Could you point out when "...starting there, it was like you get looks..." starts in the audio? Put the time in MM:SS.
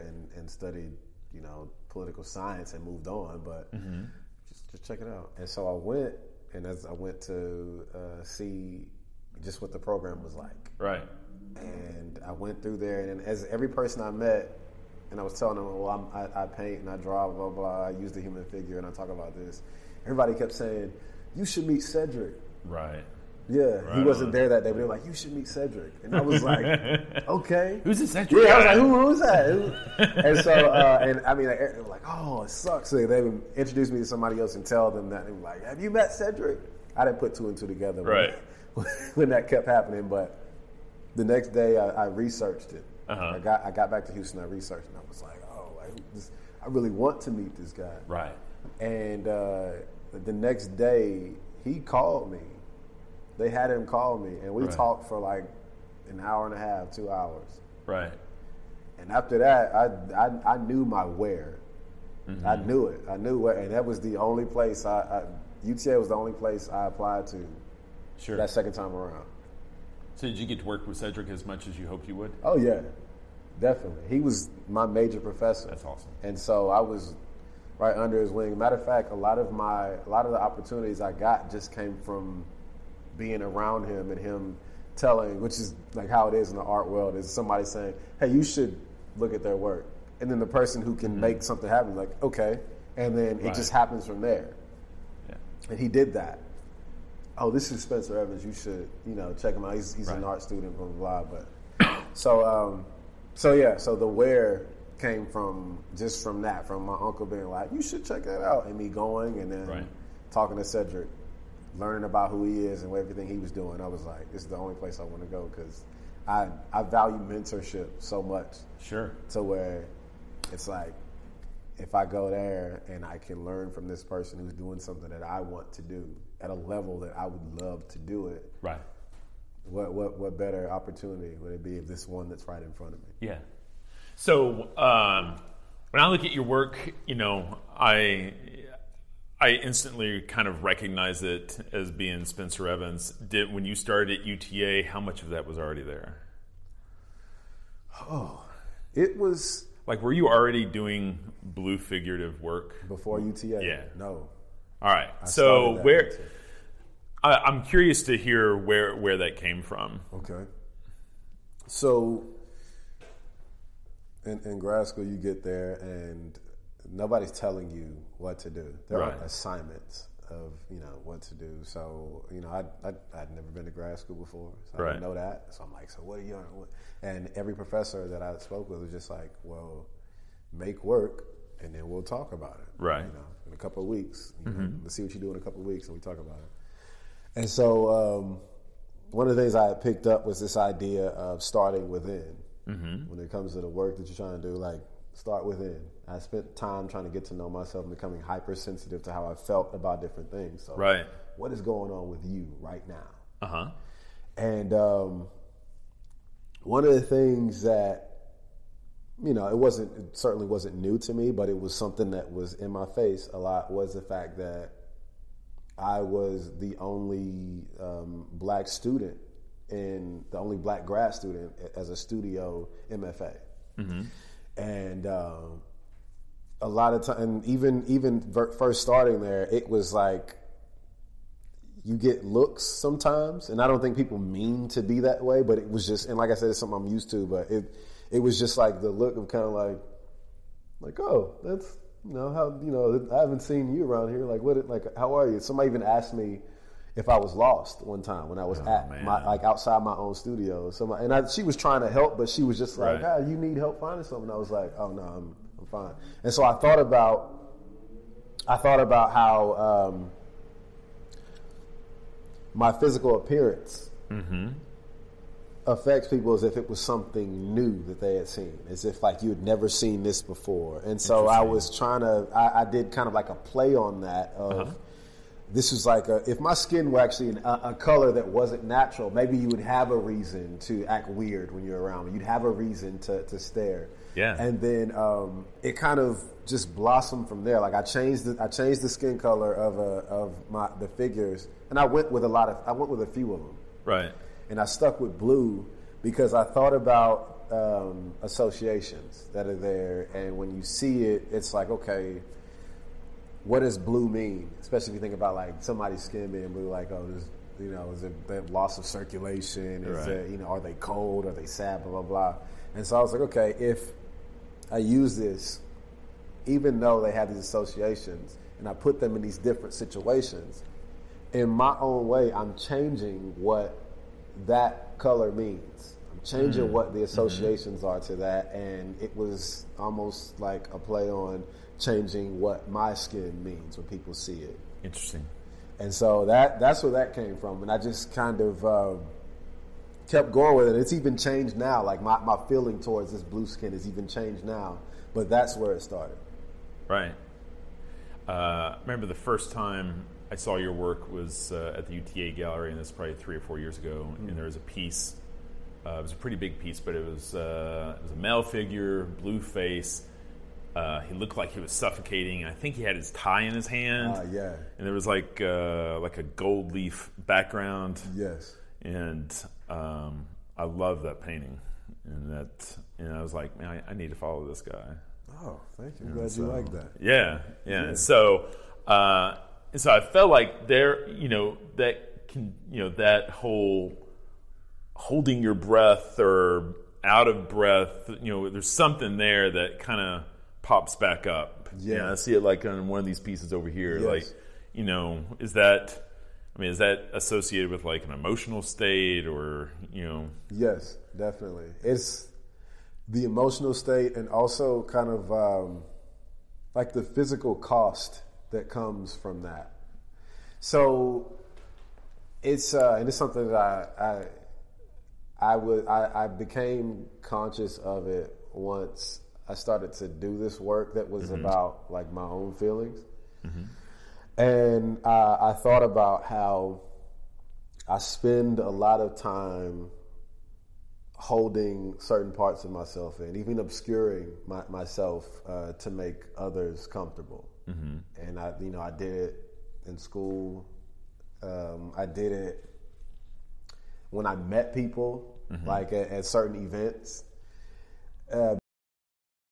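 03:48.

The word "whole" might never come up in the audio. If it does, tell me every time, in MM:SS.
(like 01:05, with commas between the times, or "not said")
06:23.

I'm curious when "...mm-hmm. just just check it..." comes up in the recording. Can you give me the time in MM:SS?
00:03.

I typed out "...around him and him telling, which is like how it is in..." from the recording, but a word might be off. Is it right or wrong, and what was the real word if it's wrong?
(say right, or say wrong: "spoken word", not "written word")
right.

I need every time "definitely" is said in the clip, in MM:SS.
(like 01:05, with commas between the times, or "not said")
01:13, 06:41.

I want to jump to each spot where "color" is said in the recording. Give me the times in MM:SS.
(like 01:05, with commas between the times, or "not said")
04:37, 04:49, 05:24.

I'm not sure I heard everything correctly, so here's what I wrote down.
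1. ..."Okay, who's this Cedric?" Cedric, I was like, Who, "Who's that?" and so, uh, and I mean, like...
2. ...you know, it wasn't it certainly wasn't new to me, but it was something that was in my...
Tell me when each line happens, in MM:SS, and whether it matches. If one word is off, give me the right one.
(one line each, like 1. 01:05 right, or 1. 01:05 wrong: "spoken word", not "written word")
1. 00:27 wrong: "Yeah", not "Cedric"
2. 03:29 right.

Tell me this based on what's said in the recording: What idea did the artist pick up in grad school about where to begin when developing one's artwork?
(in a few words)
starting within.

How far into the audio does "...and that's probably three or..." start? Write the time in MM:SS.
05:52.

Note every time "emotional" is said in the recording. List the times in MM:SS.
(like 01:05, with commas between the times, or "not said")
06:38, 06:43.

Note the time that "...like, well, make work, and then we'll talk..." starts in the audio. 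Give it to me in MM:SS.
02:59.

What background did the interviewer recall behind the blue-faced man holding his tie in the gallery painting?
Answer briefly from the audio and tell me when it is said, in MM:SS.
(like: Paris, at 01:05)
gold leaf, at 06:06.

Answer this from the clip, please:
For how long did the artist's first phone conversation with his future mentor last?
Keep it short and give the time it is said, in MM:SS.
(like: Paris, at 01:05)
an hour and a half, two hours, at 00:56.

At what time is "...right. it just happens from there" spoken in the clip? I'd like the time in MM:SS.
01:33.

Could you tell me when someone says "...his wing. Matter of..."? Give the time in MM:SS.
01:18.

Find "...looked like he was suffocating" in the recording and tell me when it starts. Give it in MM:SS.
06:01.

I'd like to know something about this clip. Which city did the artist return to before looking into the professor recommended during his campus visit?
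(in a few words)
Houston.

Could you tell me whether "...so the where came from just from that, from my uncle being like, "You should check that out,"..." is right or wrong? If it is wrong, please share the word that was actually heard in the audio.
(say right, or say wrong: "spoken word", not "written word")
right.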